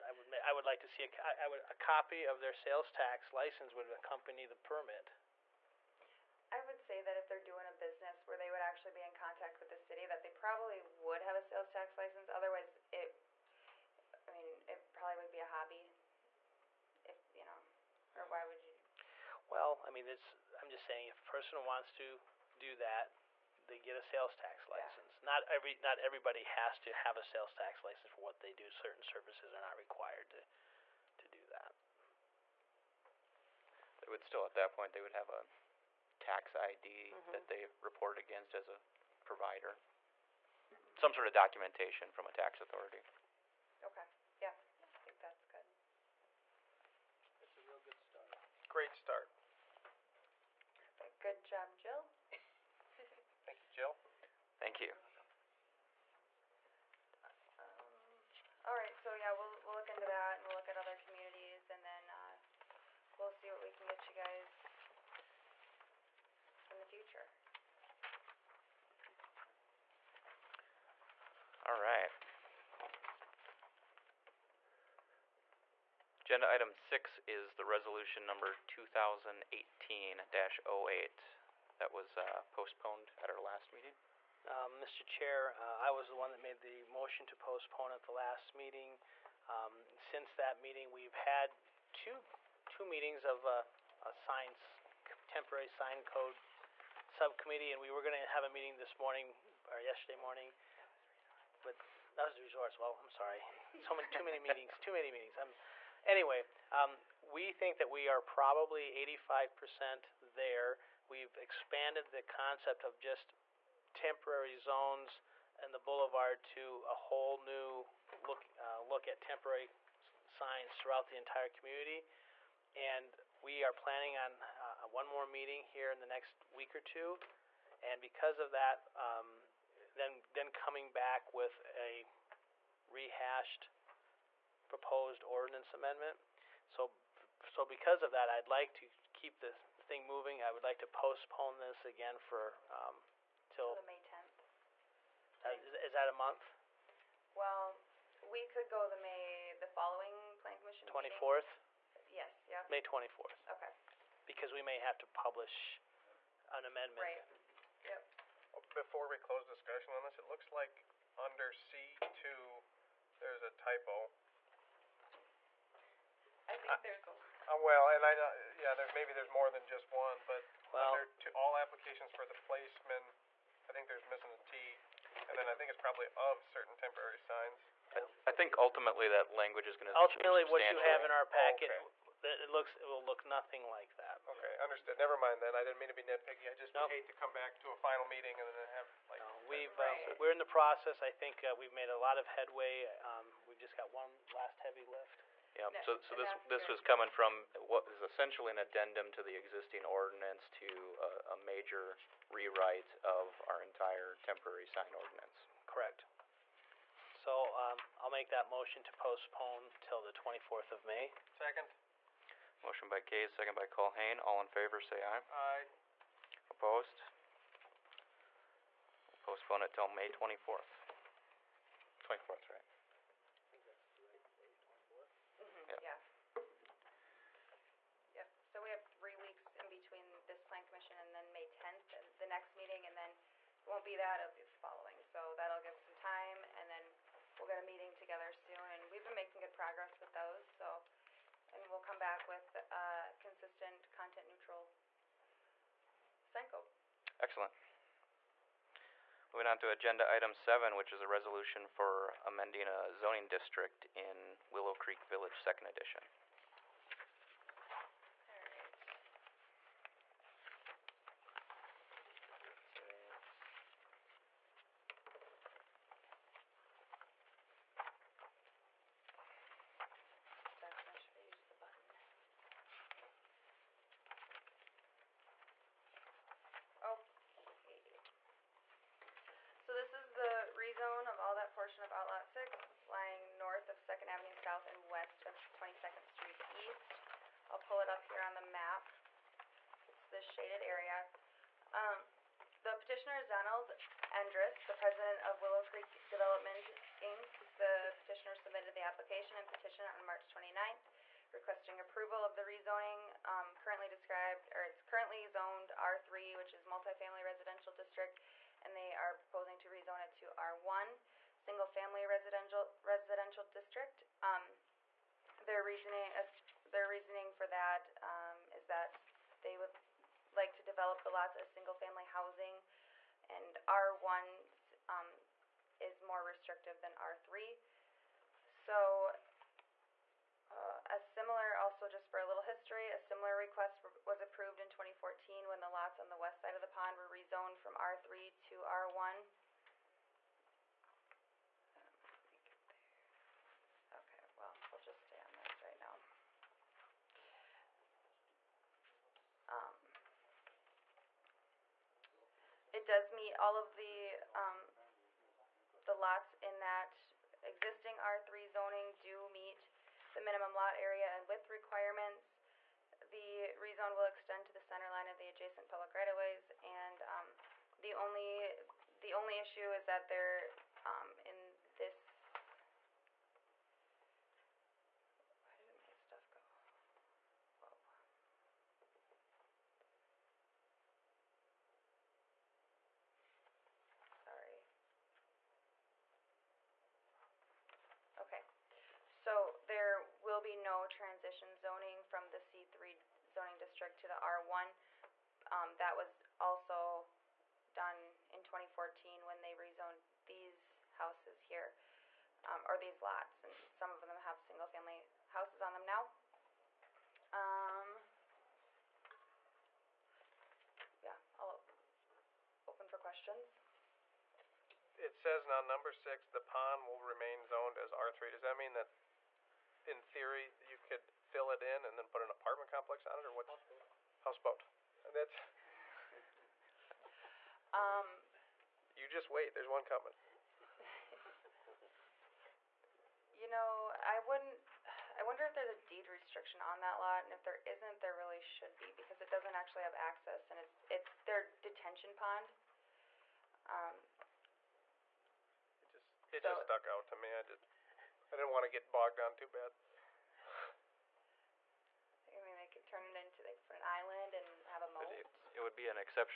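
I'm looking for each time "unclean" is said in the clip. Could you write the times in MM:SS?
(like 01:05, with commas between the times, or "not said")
not said.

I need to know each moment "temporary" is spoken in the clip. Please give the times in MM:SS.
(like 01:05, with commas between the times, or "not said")
01:35, 01:53, 01:59, 02:56, 03:24.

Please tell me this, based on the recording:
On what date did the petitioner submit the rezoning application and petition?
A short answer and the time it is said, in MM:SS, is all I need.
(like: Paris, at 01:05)
March 29th, at 05:00.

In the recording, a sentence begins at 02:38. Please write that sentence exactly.
Before we close discussion on this, it looks like under C two, there's a typo.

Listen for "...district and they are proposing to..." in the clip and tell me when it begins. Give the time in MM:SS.
05:07.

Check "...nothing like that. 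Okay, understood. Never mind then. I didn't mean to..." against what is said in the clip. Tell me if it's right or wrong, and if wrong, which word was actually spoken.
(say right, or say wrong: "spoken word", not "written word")
right.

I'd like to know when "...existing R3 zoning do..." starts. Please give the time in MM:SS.
05:57.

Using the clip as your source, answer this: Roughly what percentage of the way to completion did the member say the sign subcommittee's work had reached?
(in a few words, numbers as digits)
85%.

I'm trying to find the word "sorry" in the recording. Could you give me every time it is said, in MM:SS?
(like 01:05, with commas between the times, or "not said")
01:43, 06:24.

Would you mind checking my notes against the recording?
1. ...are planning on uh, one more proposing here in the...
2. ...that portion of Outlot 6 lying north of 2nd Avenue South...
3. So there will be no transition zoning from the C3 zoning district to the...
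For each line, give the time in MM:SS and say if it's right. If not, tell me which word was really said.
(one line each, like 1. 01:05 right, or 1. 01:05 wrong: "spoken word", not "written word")
1. 02:03 wrong: "meeting", not "proposing"
2. 04:41 right
3. 06:29 right.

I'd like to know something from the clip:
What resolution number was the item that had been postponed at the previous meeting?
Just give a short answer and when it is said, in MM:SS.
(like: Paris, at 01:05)
2018-08, at 01:17.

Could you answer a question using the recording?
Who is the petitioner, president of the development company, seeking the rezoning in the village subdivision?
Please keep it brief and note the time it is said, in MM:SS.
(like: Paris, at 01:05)
Donald Endress, at 04:53.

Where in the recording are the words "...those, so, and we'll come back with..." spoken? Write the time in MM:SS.
04:00.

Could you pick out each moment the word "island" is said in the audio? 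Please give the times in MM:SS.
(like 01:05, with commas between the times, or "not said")
07:33.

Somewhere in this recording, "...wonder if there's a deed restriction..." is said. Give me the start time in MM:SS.
07:15.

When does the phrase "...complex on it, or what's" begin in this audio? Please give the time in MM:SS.
07:02.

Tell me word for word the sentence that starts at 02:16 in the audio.
So, so because of that, I'd like to keep the thing moving.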